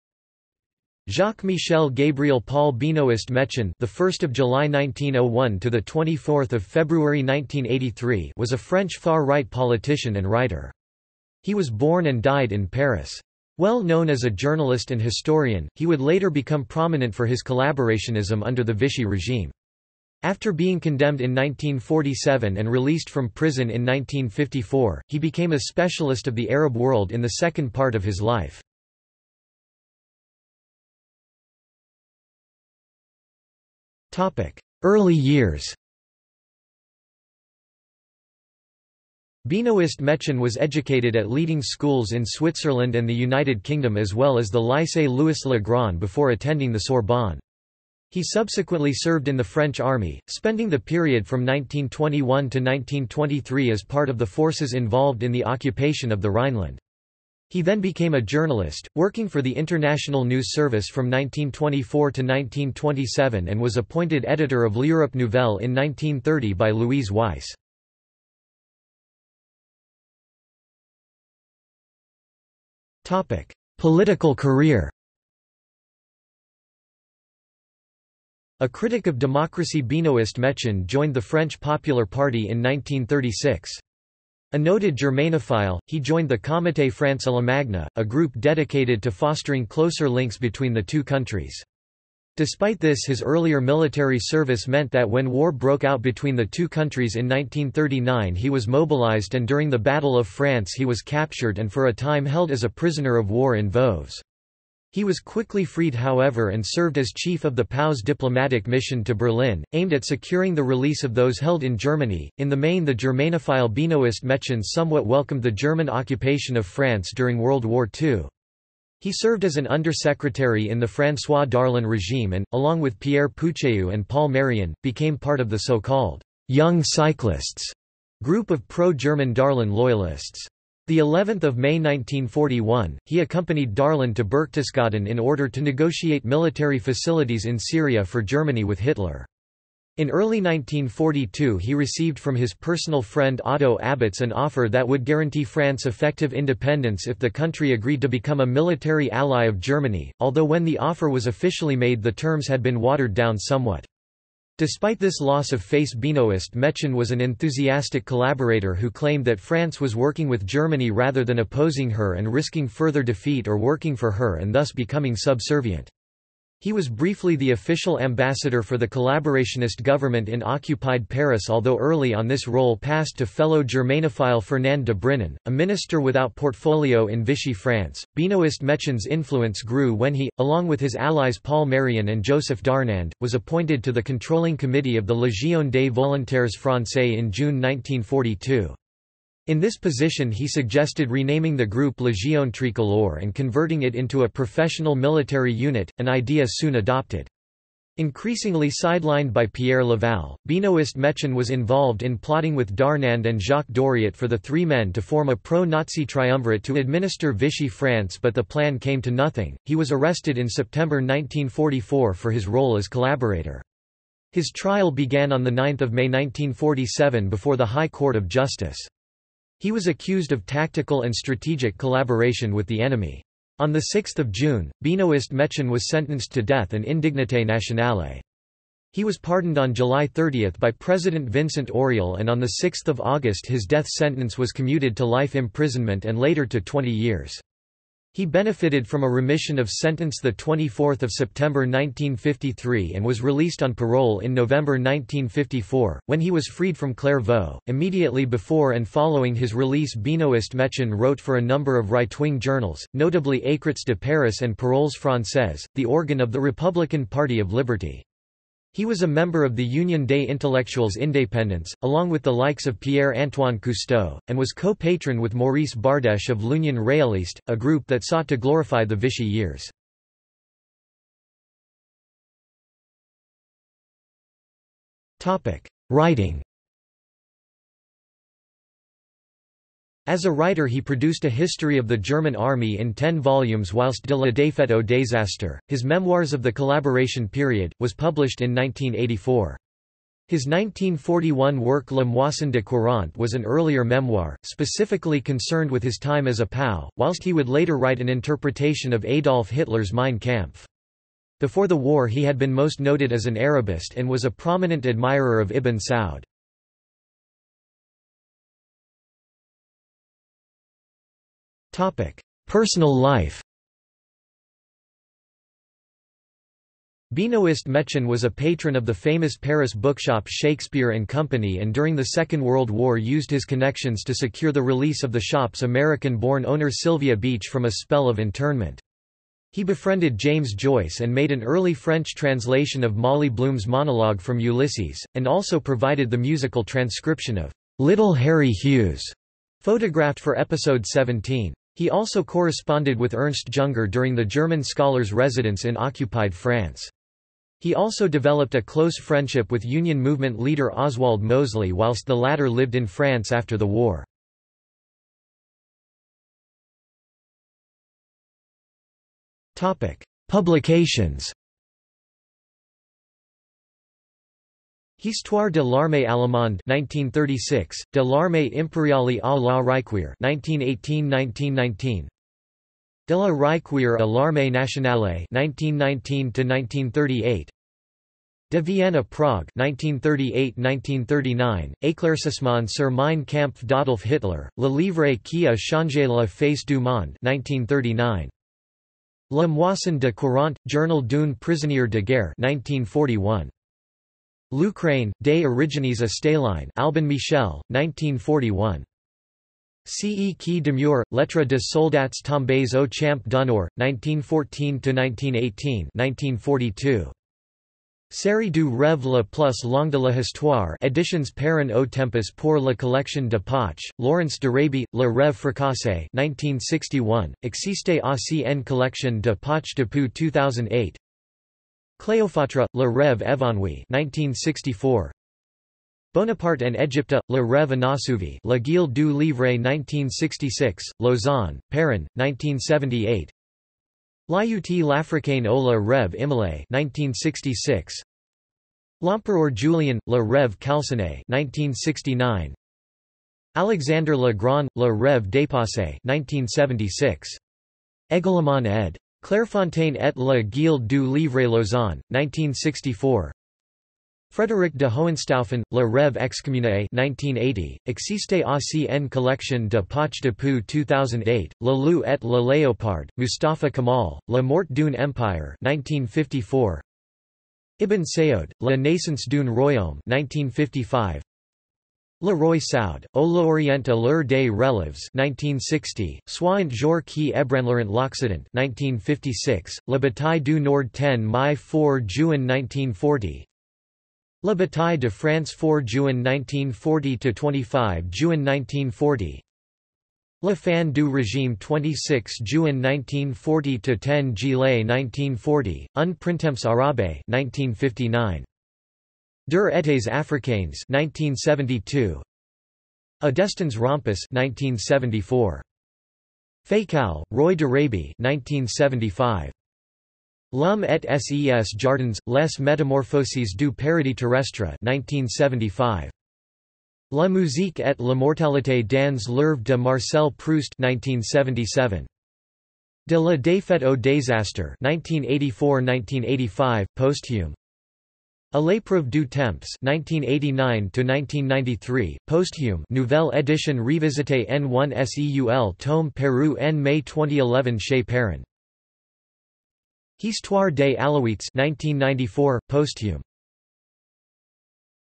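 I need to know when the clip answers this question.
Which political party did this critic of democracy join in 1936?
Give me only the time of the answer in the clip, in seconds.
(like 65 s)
81 s.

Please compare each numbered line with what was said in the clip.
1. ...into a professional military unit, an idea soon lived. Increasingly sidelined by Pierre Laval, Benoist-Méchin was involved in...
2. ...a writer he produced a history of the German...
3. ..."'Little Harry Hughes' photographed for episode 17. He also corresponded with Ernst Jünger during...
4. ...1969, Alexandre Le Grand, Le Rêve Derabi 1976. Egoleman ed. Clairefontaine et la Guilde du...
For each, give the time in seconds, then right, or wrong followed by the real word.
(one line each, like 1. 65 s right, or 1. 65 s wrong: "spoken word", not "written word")
1. 193 s wrong: "adopted", not "lived"
2. 280 s right
3. 337 s right
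4. 441 s wrong: "Dépassé", not "Derabi".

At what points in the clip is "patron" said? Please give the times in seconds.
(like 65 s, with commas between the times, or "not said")
264 s, 318 s.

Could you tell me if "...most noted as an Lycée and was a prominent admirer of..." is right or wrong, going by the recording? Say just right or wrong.
wrong.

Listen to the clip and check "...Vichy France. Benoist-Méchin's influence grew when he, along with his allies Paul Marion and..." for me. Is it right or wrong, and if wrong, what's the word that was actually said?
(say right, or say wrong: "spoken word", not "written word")
right.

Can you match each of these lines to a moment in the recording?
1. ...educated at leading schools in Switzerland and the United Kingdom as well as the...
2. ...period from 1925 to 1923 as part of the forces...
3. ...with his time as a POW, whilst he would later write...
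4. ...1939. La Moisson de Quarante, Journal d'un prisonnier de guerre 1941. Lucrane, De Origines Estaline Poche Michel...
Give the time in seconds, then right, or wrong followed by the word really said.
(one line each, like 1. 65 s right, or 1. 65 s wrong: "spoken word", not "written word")
1. 40 s right
2. 50 s wrong: "1921", not "1925"
3. 295 s right
4. 387 s wrong: "Albin", not "Poche".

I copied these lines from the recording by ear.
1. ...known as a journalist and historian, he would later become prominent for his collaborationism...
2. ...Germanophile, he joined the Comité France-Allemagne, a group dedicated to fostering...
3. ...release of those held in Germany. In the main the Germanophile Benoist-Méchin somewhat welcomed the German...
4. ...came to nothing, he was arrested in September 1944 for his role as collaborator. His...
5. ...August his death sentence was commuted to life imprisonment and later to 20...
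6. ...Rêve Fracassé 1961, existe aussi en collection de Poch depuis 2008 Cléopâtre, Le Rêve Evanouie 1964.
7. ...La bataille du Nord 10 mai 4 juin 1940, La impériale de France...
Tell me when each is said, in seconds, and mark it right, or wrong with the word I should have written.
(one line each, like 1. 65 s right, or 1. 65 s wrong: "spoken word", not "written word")
1. 13 s right
2. 84 s right
3. 110 s right
4. 208 s right
5. 233 s right
6. 415 s right
7. 479 s wrong: "bataille", not "impériale".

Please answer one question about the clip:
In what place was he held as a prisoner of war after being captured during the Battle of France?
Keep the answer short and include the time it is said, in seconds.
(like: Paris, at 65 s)
Voves, at 103 s.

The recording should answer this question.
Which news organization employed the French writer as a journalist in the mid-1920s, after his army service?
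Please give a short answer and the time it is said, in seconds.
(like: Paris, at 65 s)
International News Service, at 59 s.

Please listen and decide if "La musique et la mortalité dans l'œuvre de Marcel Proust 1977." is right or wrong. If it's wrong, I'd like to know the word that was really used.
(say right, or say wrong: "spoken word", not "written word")
right.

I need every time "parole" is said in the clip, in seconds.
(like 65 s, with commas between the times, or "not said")
243 s, 254 s.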